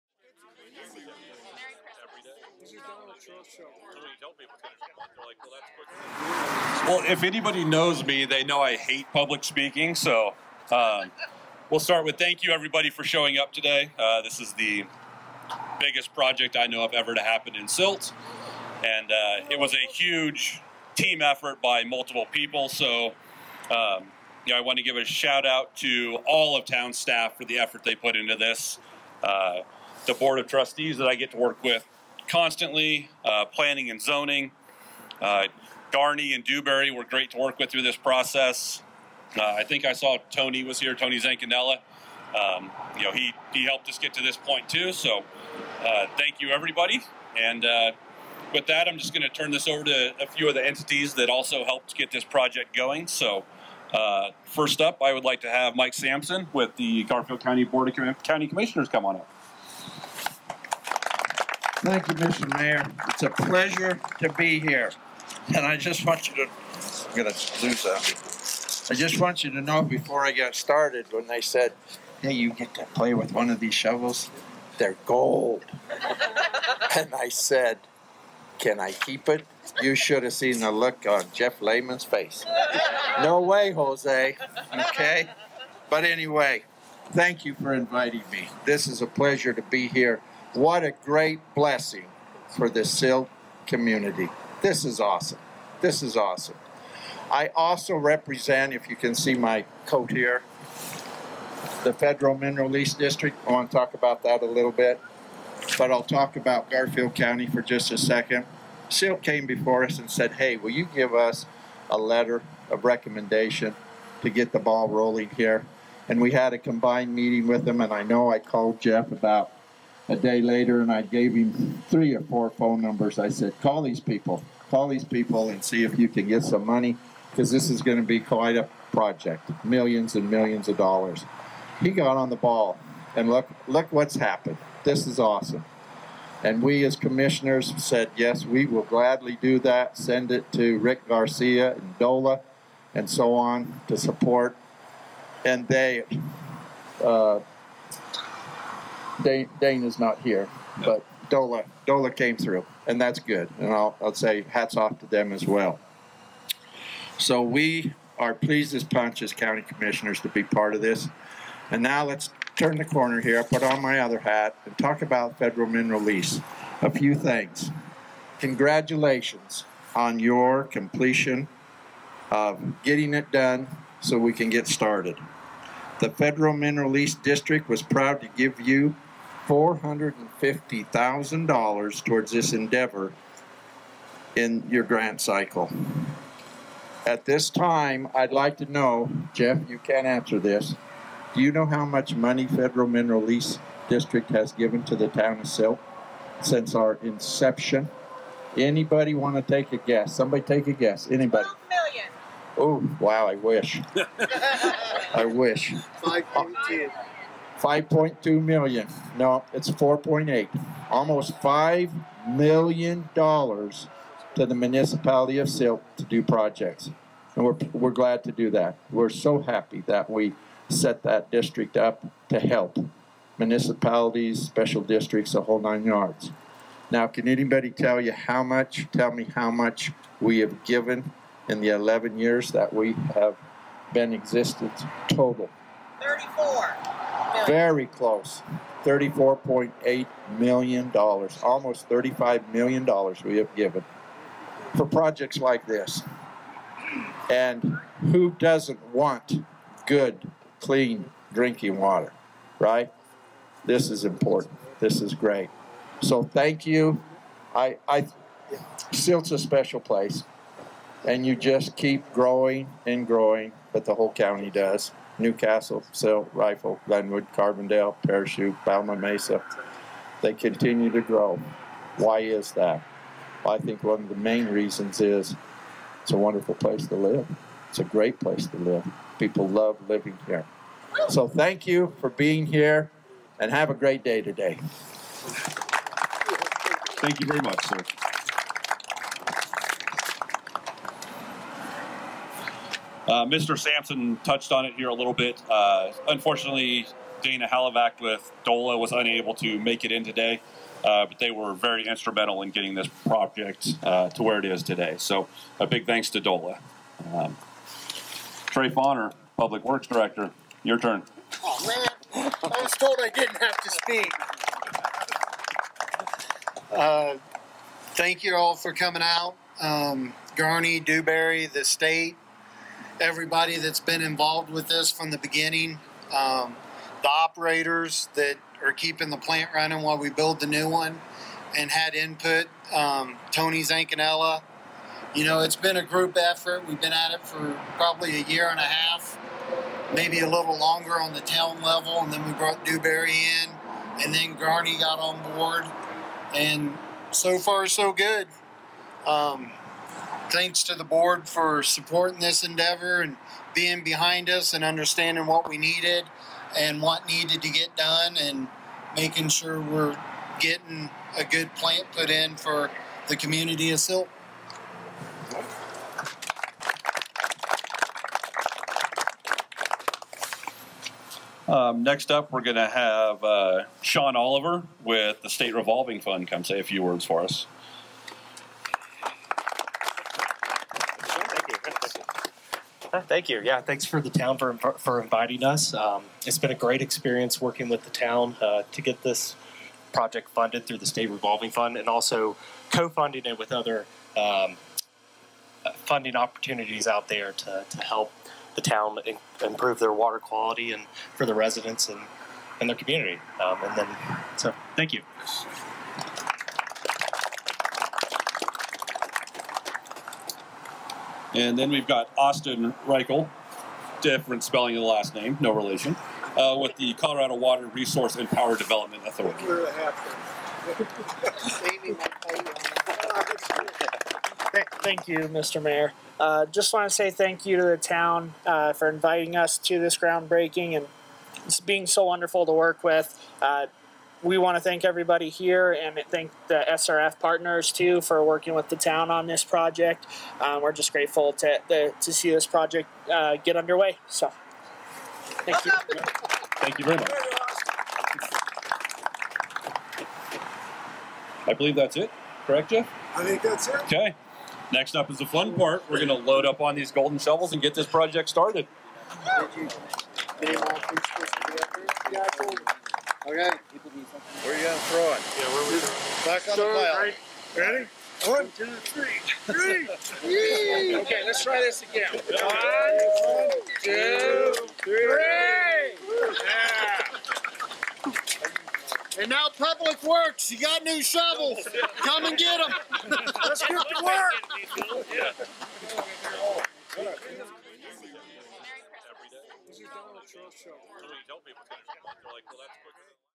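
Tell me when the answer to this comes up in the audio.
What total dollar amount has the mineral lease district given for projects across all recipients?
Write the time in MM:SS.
03:58.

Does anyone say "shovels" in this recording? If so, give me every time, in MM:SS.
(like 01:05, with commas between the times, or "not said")
01:13, 07:37, 08:01.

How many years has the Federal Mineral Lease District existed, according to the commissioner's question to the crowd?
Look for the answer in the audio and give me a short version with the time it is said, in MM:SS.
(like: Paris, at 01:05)
11, at 03:51.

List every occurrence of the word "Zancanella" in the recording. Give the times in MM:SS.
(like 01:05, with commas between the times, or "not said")
00:41, 05:33.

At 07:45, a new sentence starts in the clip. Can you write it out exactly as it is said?
Yeah, where we Back on the pile.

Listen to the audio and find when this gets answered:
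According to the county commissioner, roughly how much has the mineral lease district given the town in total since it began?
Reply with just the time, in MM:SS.
03:29.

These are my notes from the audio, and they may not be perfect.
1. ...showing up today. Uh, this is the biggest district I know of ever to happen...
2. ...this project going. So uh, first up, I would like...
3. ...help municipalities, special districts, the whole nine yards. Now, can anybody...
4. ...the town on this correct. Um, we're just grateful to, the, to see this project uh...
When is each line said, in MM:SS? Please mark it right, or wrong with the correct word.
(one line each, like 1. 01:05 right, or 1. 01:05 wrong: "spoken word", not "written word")
1. 00:13 wrong: "project", not "district"
2. 00:52 right
3. 03:42 right
4. 07:18 wrong: "project", not "correct".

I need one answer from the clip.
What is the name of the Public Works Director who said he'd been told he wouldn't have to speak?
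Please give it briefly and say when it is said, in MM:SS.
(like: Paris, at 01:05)
Trey Fauner, at 05:08.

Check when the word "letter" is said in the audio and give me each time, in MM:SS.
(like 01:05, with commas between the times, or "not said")
01:51.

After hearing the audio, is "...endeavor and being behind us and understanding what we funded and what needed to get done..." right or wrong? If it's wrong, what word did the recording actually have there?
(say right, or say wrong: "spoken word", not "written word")
wrong: "needed", not "funded".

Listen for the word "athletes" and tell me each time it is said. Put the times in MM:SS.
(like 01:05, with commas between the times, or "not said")
not said.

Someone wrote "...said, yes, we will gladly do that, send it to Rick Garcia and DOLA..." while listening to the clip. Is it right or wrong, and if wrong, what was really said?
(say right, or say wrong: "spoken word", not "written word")
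right.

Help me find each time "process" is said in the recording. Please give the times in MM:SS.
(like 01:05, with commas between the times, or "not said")
00:37.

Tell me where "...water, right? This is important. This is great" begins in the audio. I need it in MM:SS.
04:11.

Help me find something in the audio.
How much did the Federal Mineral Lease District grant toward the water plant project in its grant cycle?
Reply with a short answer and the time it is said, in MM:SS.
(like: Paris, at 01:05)
$450,000, at 02:59.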